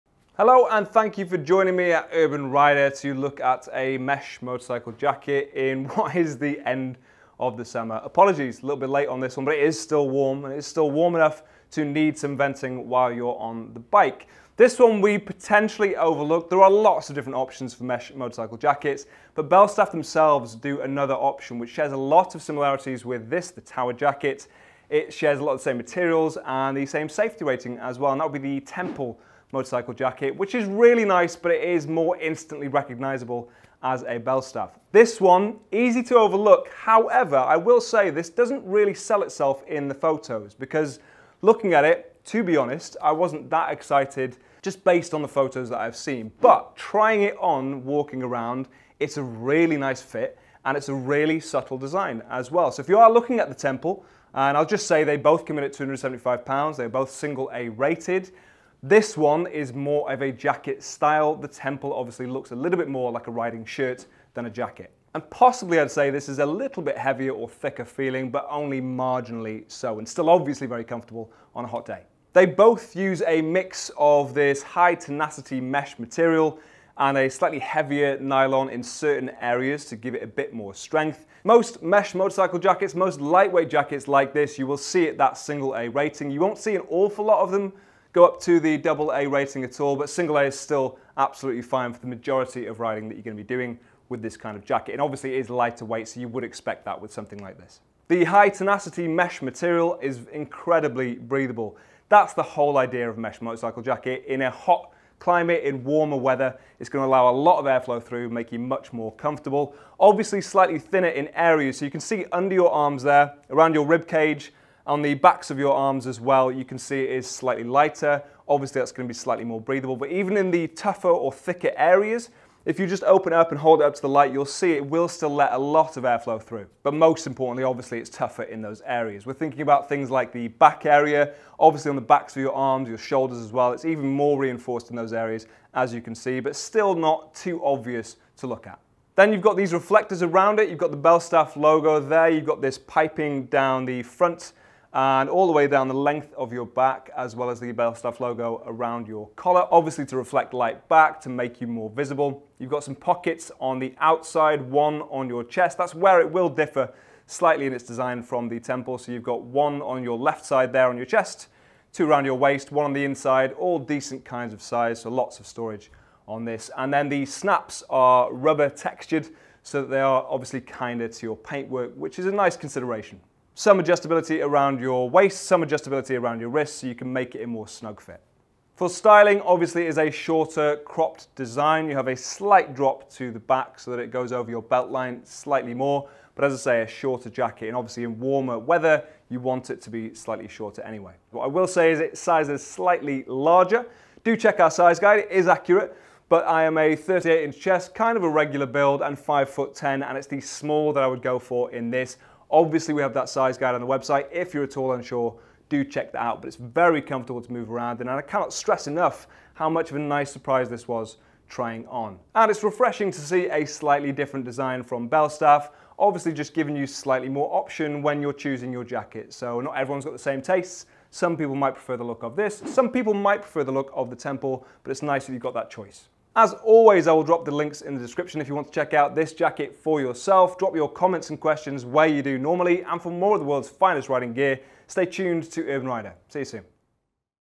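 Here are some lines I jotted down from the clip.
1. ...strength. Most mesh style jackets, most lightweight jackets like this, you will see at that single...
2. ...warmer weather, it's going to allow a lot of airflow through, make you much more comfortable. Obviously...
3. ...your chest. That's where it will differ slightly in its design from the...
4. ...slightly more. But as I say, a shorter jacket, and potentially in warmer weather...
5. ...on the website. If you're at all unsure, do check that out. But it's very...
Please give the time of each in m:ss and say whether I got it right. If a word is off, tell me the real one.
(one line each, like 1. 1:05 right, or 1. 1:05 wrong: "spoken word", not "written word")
1. 1:20 wrong: "motorcycle", not "style"
2. 1:45 right
3. 2:35 right
4. 3:05 wrong: "obviously", not "potentially"
5. 3:23 right.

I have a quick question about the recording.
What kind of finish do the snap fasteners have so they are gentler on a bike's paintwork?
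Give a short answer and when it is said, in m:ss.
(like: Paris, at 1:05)
Rubber textured, at 2:48.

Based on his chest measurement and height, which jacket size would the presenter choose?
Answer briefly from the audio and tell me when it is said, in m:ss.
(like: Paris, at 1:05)
Small, at 3:20.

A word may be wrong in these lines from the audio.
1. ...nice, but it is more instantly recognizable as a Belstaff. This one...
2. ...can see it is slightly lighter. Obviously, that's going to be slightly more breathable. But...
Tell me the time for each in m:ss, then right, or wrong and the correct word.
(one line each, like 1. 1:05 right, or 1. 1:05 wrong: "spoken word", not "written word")
1. 0:31 right
2. 1:56 right.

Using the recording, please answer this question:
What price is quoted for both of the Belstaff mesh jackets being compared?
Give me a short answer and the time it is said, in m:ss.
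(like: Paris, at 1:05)
£275, at 0:55.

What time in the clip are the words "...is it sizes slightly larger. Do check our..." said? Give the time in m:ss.
3:11.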